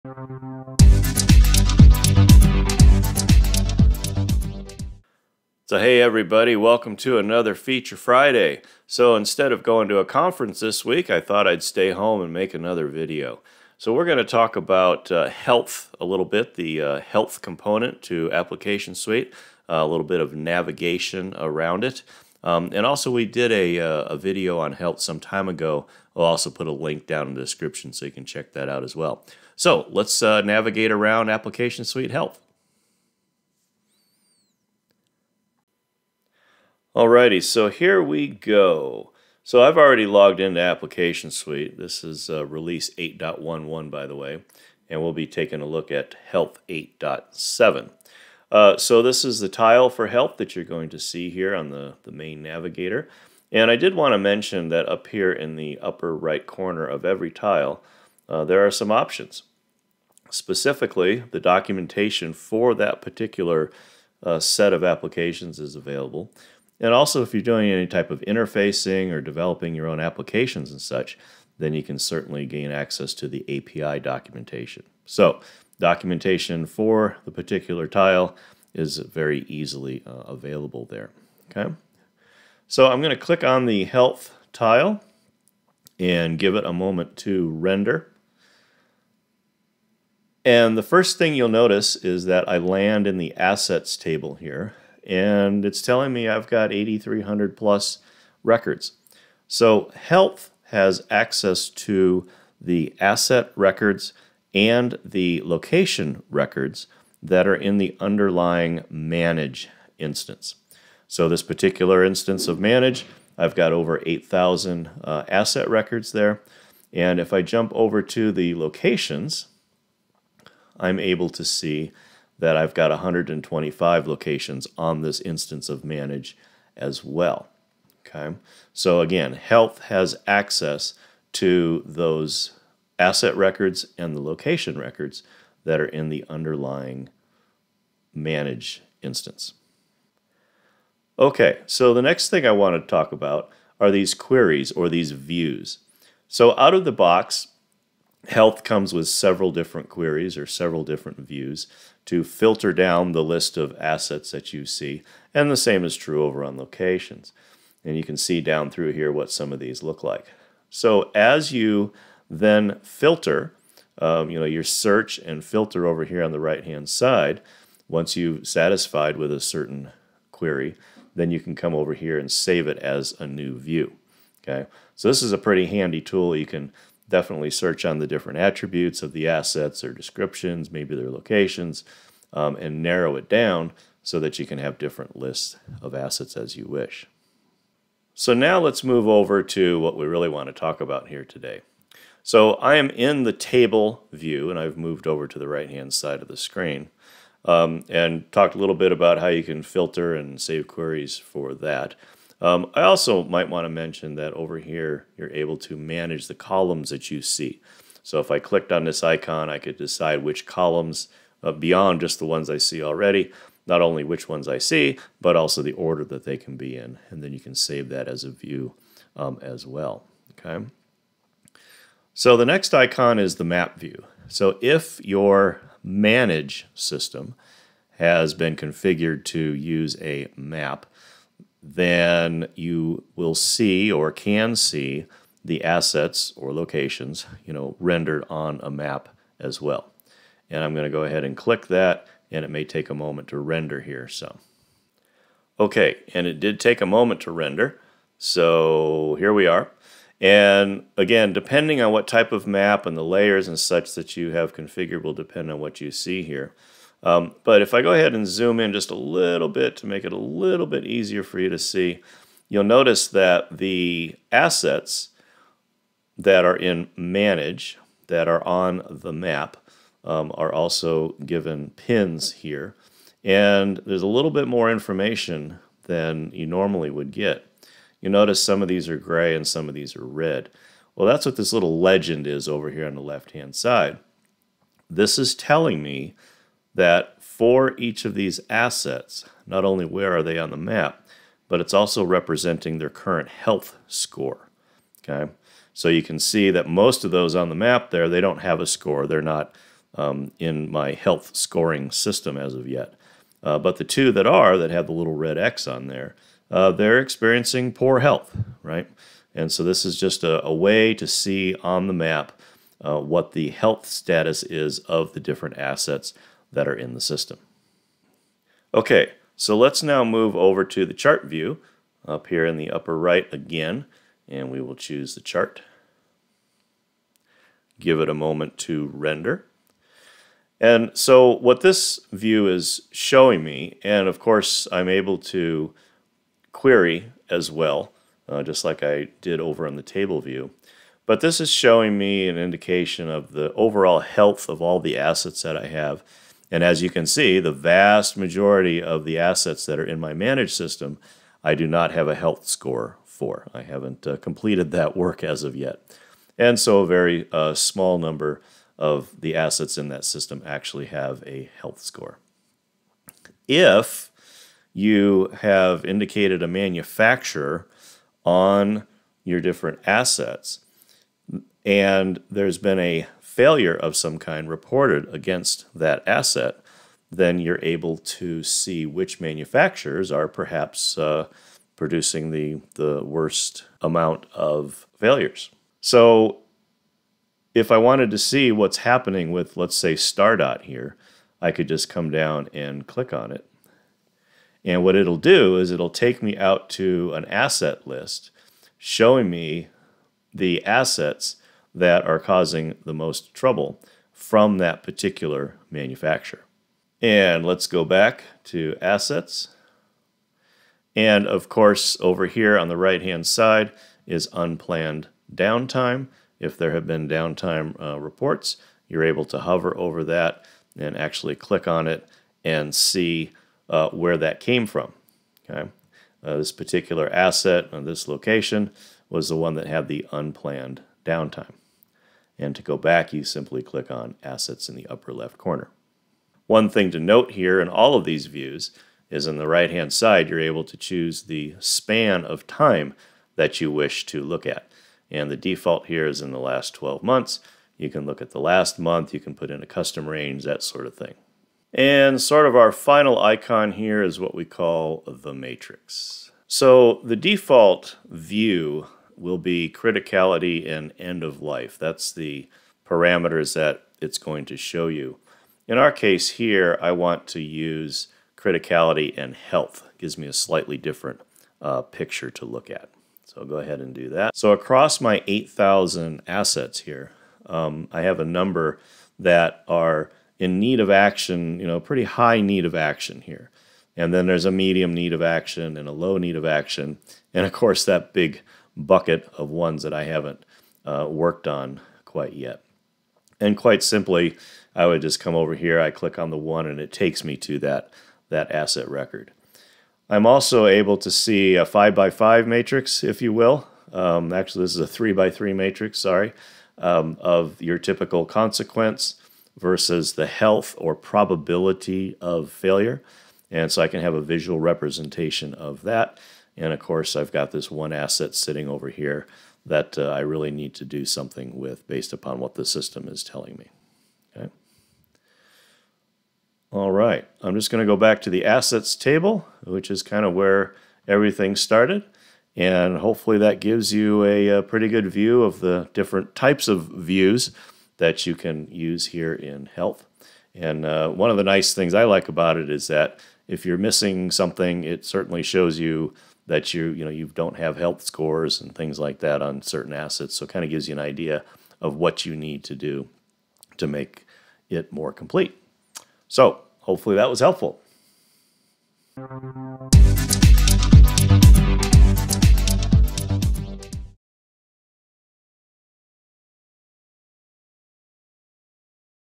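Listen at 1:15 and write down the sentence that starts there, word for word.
So, documentation for the particular tile is very easily uh, available there.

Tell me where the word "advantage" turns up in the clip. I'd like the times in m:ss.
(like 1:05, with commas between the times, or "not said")
not said.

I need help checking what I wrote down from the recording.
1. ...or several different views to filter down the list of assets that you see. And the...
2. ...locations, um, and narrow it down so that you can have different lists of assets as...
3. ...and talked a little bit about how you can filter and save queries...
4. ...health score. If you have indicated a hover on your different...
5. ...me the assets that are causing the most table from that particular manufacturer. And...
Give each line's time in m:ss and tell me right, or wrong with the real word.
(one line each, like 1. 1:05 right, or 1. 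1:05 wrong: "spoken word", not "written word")
1. 2:30 right
2. 3:01 right
3. 3:17 right
4. 6:01 wrong: "manufacturer", not "hover"
5. 6:39 wrong: "trouble", not "table".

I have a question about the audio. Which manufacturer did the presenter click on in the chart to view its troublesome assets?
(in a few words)
Stardot.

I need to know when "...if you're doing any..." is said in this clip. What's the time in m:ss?
1:07.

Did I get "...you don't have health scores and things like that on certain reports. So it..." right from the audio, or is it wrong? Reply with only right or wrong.
wrong.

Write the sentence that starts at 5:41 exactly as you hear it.
But this is showing me an indication of the overall health of all the assets that I have.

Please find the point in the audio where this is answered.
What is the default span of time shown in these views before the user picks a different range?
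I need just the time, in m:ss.
7:26.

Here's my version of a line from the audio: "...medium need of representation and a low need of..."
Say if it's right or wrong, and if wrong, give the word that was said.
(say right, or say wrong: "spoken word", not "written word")
wrong: "action", not "representation".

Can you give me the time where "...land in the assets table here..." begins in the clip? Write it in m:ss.
1:32.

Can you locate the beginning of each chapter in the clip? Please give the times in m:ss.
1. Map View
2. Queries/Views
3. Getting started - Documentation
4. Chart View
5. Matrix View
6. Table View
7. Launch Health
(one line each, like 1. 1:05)
1. 3:42
2. 2:20
3. 0:35
4. 5:19
5. 7:31
6. 3:07
7. 1:23.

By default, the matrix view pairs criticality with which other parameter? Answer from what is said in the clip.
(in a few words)
end of life.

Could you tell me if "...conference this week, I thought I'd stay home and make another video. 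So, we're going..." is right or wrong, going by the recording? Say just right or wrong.
right.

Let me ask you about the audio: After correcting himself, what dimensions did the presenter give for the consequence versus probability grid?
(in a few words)
3 by 3.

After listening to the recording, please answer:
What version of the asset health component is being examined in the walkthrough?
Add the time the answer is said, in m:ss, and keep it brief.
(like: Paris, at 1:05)
8.7, at 0:46.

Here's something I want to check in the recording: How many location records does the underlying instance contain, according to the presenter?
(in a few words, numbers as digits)
125.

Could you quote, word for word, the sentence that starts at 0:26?
I'll also put a link down in the description so you can check that out as well.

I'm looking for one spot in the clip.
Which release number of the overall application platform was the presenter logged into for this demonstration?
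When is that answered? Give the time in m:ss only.
0:42.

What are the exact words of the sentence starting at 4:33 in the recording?
And there's a little bit more information than you normally would get.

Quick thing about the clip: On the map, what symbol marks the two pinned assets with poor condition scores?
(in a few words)
red X.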